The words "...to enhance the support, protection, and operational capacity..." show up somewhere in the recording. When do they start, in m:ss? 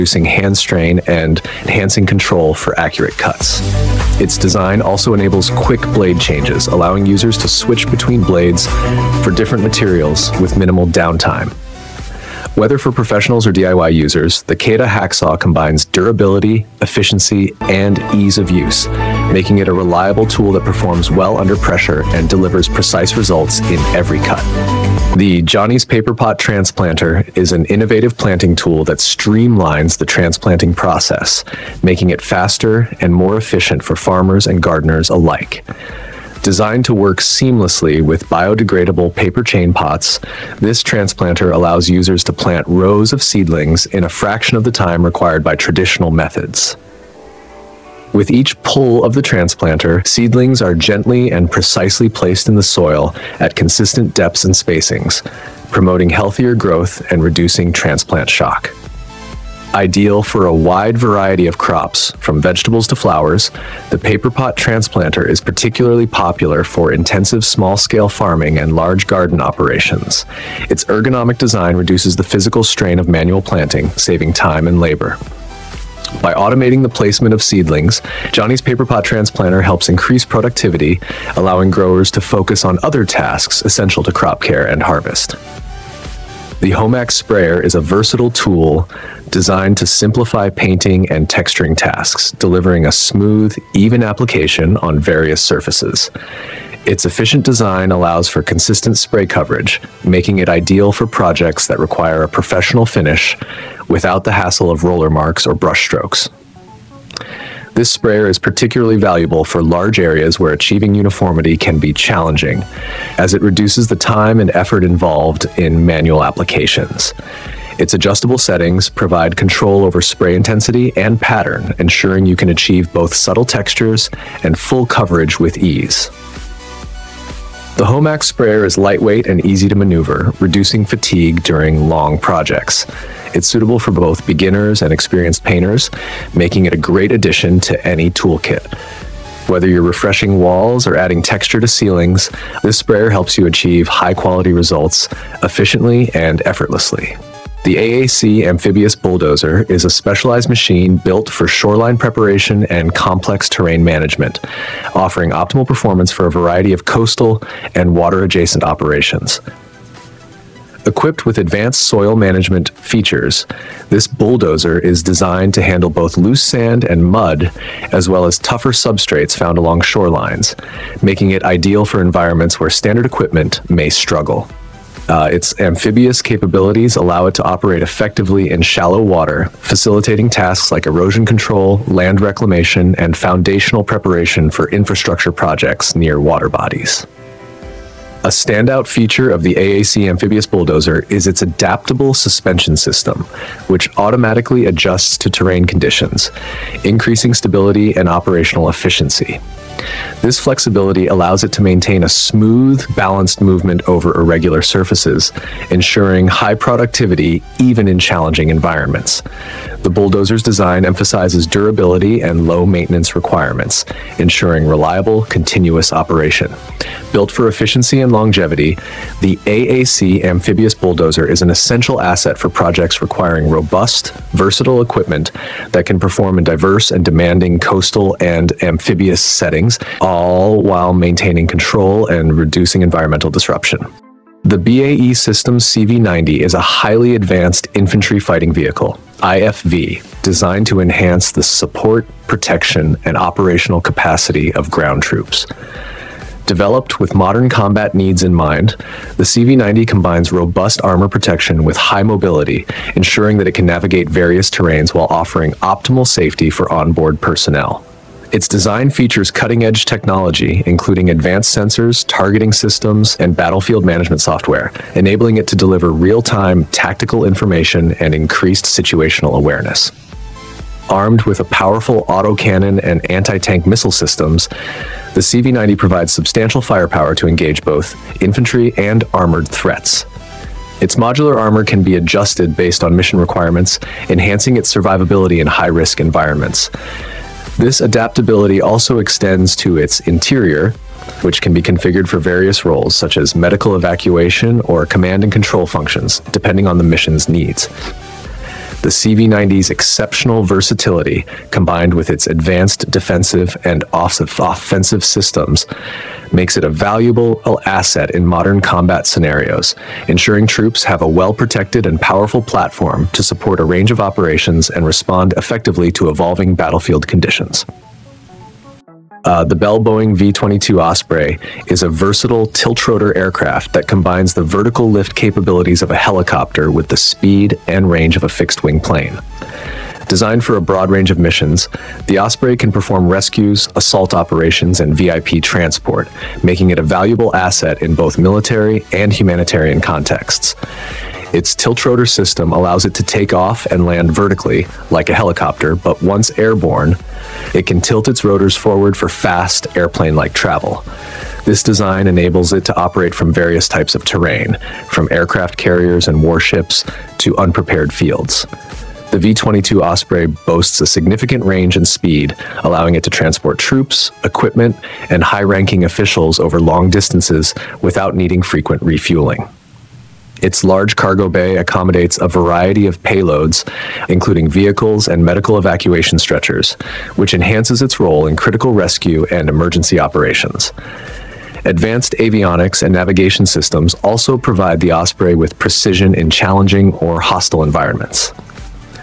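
4:00.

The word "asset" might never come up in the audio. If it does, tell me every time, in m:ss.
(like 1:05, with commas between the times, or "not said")
3:42, 5:07, 5:37.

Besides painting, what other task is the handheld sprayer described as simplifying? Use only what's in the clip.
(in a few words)
Texturing.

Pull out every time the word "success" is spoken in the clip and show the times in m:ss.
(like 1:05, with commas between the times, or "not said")
not said.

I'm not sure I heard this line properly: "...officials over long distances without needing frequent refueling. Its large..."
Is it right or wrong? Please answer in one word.
right.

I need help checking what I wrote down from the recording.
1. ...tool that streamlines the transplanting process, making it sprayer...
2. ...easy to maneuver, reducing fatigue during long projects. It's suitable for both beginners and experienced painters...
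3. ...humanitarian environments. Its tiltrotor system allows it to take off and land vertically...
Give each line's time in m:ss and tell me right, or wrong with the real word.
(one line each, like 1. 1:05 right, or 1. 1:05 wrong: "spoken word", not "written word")
1. 0:28 wrong: "faster", not "sprayer"
2. 2:09 right
3. 5:39 wrong: "contexts", not "environments".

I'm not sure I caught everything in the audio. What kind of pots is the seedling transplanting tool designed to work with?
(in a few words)
Biodegradable paper chain pots.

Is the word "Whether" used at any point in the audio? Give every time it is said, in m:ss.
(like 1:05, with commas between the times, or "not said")
0:12, 2:19.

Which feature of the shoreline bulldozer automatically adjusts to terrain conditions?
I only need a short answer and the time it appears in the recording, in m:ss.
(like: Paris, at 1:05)
Adaptable suspension system, at 3:11.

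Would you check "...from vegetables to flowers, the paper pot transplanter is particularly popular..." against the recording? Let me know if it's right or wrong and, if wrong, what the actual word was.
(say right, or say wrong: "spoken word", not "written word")
right.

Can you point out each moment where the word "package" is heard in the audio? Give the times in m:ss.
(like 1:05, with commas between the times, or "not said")
not said.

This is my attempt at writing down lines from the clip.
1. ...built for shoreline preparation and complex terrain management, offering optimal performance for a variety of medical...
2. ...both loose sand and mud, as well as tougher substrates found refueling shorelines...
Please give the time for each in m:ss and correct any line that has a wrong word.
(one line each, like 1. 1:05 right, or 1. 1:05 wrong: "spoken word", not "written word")
1. 2:30 wrong: "coastal", not "medical"
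2. 2:45 wrong: "along", not "refueling".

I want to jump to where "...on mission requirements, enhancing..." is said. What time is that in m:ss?
4:42.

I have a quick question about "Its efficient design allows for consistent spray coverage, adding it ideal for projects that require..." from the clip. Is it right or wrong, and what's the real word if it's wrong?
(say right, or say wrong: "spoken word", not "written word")
wrong: "making", not "adding".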